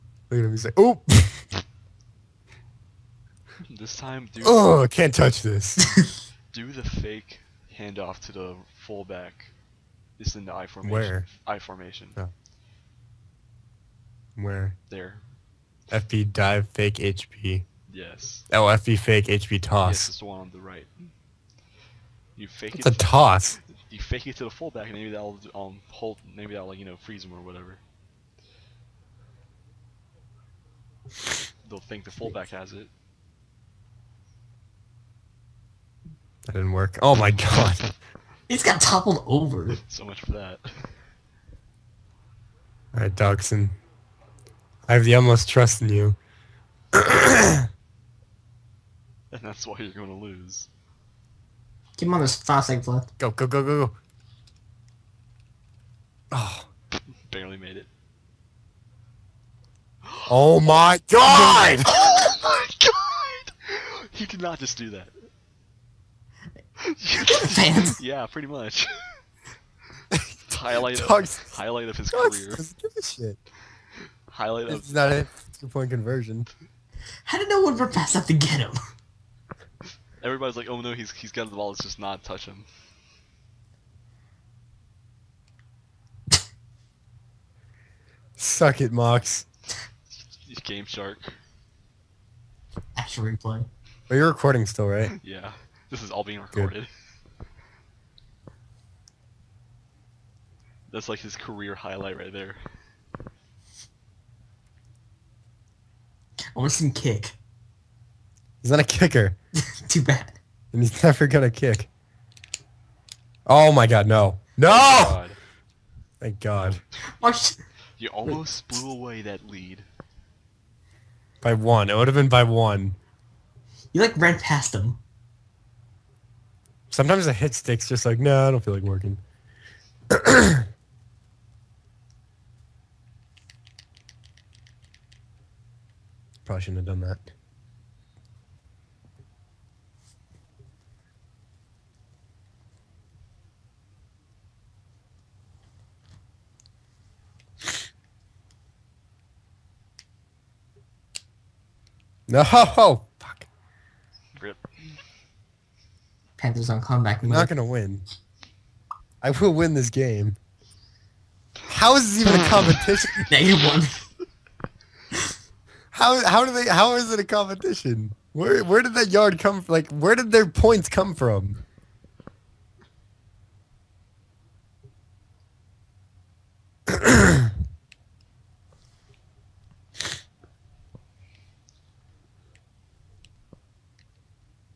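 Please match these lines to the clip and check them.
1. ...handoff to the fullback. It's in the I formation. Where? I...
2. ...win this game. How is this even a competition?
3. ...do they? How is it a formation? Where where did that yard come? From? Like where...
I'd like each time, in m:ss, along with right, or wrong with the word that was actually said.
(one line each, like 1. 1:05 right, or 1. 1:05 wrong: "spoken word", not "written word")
1. 0:07 right
2. 2:39 right
3. 2:46 wrong: "competition", not "formation".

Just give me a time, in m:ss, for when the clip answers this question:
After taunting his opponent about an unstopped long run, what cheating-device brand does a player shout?
1:30.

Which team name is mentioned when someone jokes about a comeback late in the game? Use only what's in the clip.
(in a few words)
Panthers.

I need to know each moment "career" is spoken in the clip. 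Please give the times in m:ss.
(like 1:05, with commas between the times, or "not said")
1:12, 1:41.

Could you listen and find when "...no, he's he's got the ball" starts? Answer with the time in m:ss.
1:20.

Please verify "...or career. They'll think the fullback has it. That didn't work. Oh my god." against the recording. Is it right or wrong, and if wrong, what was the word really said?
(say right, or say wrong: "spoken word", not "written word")
wrong: "whatever", not "career".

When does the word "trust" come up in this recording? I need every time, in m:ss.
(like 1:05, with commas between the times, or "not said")
0:45.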